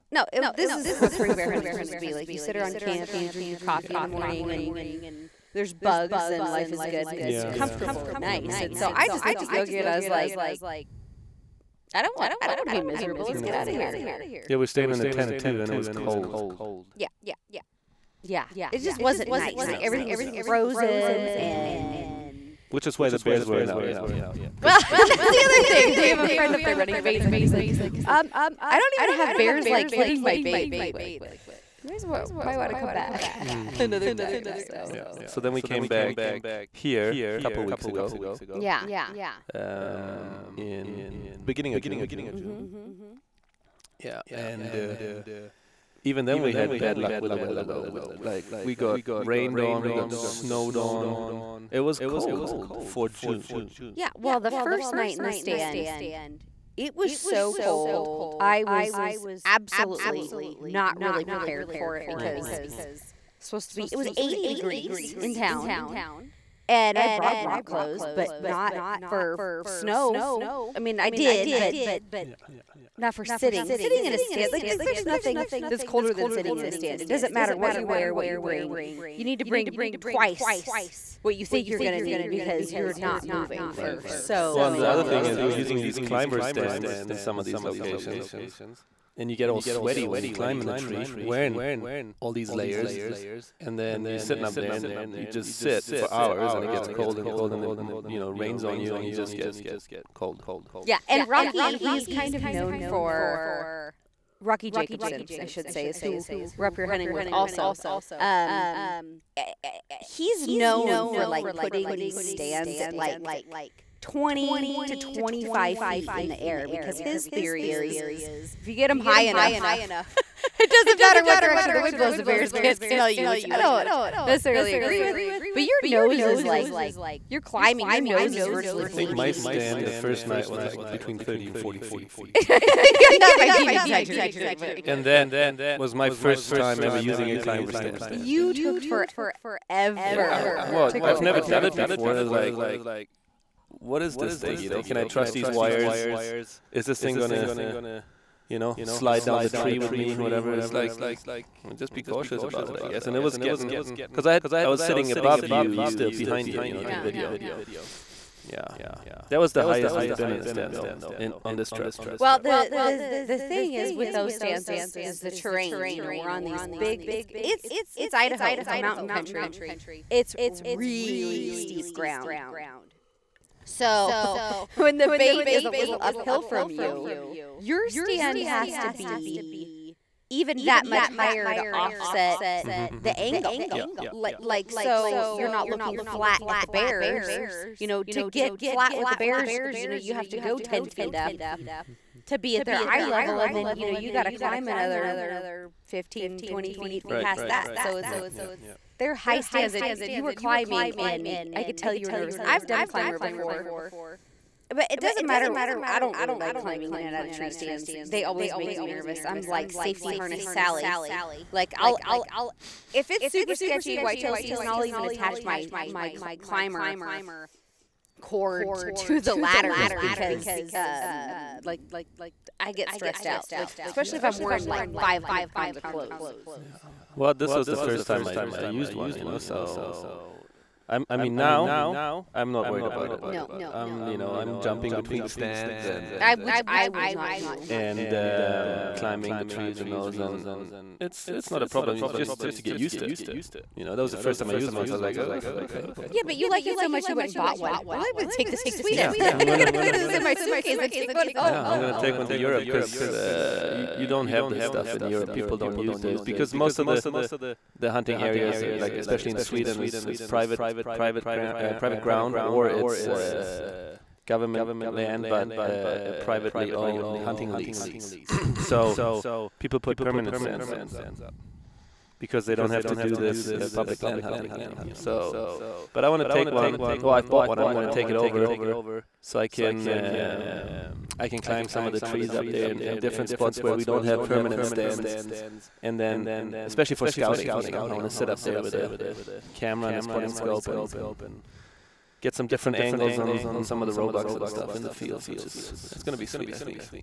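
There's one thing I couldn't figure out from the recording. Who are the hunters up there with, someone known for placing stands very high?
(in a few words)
Rocky Jacobsen.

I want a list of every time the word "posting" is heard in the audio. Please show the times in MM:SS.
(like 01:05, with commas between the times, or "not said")
not said.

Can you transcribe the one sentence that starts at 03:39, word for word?
because um like I get stressed out, like especially yeah.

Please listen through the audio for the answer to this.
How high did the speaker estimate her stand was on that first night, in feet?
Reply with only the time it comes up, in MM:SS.
02:10.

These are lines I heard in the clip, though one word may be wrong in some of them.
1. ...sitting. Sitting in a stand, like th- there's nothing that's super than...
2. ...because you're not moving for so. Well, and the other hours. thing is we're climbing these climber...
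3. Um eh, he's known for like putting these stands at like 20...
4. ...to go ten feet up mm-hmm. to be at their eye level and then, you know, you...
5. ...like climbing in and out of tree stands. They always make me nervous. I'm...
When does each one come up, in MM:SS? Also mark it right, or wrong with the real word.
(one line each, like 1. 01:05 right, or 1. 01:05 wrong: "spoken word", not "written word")
1. 01:13 wrong: "colder", not "super"
2. 01:22 wrong: "using", not "climbing"
3. 01:48 right
4. 03:10 right
5. 03:26 right.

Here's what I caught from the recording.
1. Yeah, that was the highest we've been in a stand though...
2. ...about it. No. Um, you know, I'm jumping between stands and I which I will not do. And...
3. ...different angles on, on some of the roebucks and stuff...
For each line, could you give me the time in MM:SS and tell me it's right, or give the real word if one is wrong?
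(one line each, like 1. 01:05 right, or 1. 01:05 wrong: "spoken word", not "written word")
1. 02:38 right
2. 03:52 right
3. 04:52 right.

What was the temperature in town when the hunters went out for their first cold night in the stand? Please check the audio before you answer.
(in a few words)
80 degrees.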